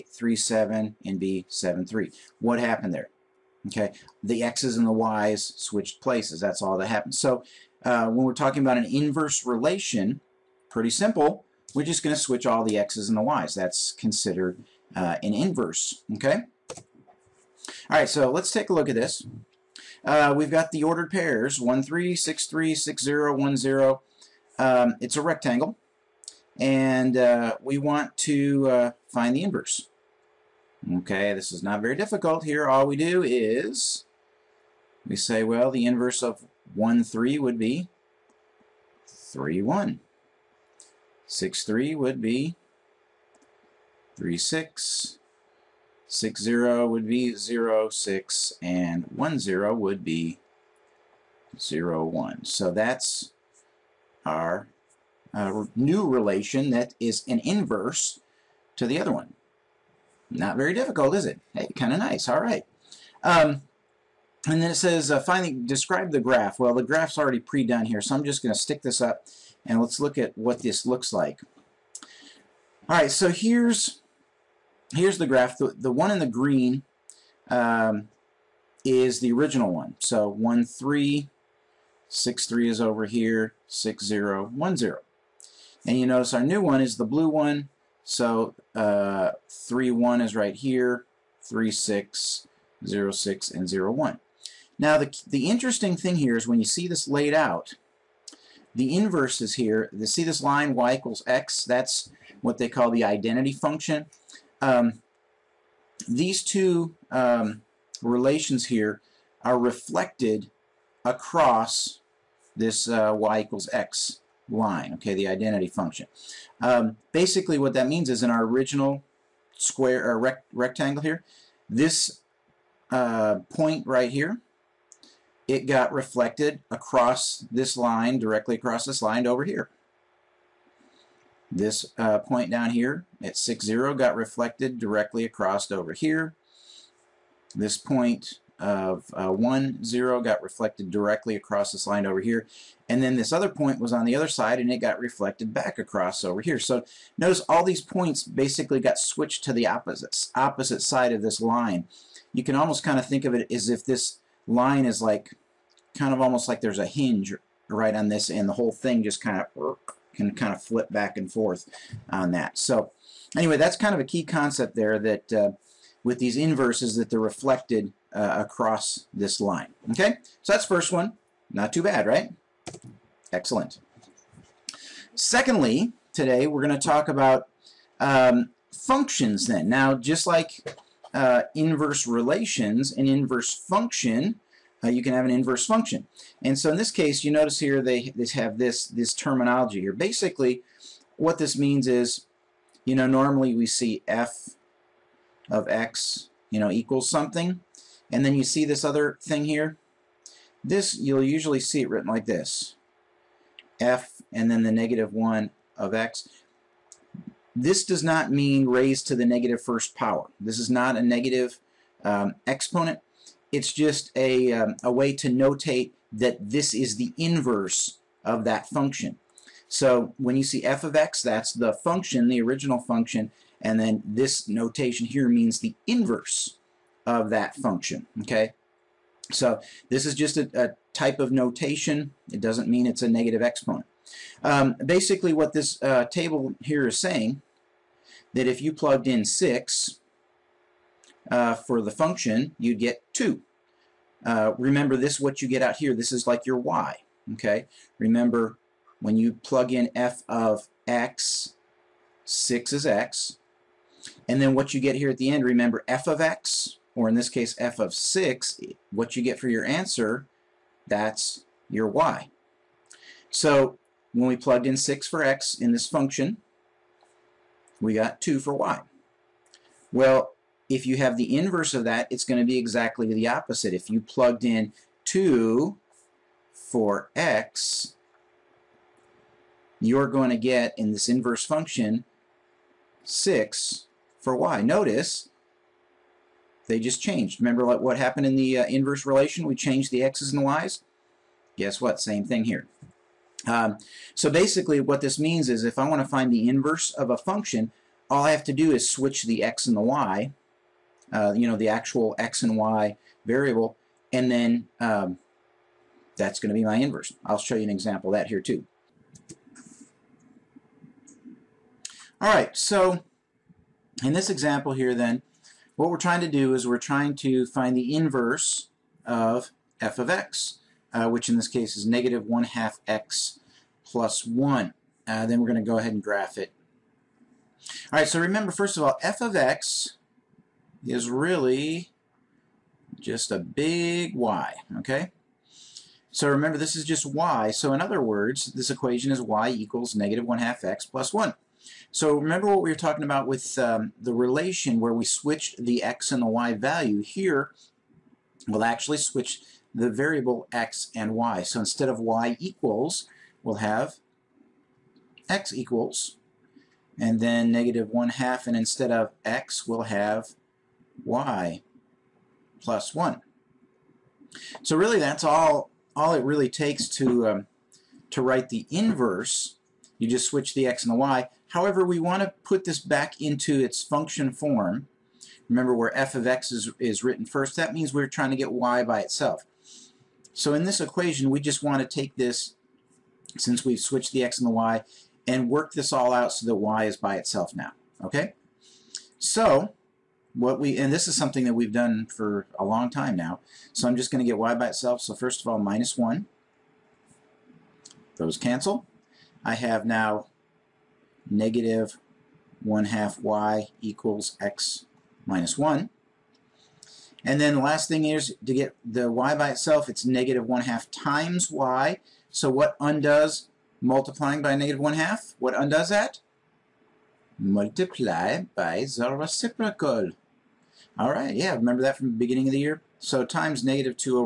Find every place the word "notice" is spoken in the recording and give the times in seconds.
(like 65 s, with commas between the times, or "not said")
86 s, 147 s, 187 s, 284 s.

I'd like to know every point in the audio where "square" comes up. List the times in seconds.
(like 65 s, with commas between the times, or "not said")
119 s.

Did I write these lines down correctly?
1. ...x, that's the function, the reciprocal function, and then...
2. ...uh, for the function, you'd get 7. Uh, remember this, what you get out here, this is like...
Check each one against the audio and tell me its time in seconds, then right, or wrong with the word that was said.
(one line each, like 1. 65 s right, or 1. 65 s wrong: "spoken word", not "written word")
1. 220 s wrong: "original", not "reciprocal"
2. 241 s wrong: "2", not "7".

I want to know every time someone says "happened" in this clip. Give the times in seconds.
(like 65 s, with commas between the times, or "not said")
2 s, 6 s, 287 s.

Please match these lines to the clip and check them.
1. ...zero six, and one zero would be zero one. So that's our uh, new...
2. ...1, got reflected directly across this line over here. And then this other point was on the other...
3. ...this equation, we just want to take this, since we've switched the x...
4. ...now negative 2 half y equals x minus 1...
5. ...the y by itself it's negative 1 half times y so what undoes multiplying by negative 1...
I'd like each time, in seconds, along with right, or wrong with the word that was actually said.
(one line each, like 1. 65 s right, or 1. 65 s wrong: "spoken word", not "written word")
1. 47 s right
2. 139 s right
3. 380 s right
4. 399 s wrong: "1", not "2"
5. 408 s right.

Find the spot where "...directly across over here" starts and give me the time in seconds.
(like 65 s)
134 s.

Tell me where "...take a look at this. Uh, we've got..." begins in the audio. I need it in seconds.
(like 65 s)
18 s.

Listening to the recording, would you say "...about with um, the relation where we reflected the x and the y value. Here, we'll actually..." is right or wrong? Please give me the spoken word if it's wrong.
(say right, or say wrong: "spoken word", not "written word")
wrong: "switched", not "reflected".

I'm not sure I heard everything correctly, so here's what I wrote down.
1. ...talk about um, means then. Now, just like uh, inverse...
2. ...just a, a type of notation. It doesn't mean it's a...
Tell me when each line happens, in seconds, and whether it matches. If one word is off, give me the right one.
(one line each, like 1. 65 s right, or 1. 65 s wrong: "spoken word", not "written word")
1. 176 s wrong: "functions", not "means"
2. 230 s right.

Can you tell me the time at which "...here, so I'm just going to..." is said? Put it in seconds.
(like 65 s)
67 s.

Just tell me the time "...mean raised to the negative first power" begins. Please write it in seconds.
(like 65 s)
208 s.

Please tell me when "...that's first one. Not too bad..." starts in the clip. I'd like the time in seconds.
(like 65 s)
170 s.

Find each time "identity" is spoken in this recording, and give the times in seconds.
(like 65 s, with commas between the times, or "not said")
103 s, 115 s.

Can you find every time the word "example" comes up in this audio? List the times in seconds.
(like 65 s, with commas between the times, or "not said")
307 s, 314 s.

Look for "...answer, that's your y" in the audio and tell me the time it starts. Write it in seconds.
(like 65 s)
259 s.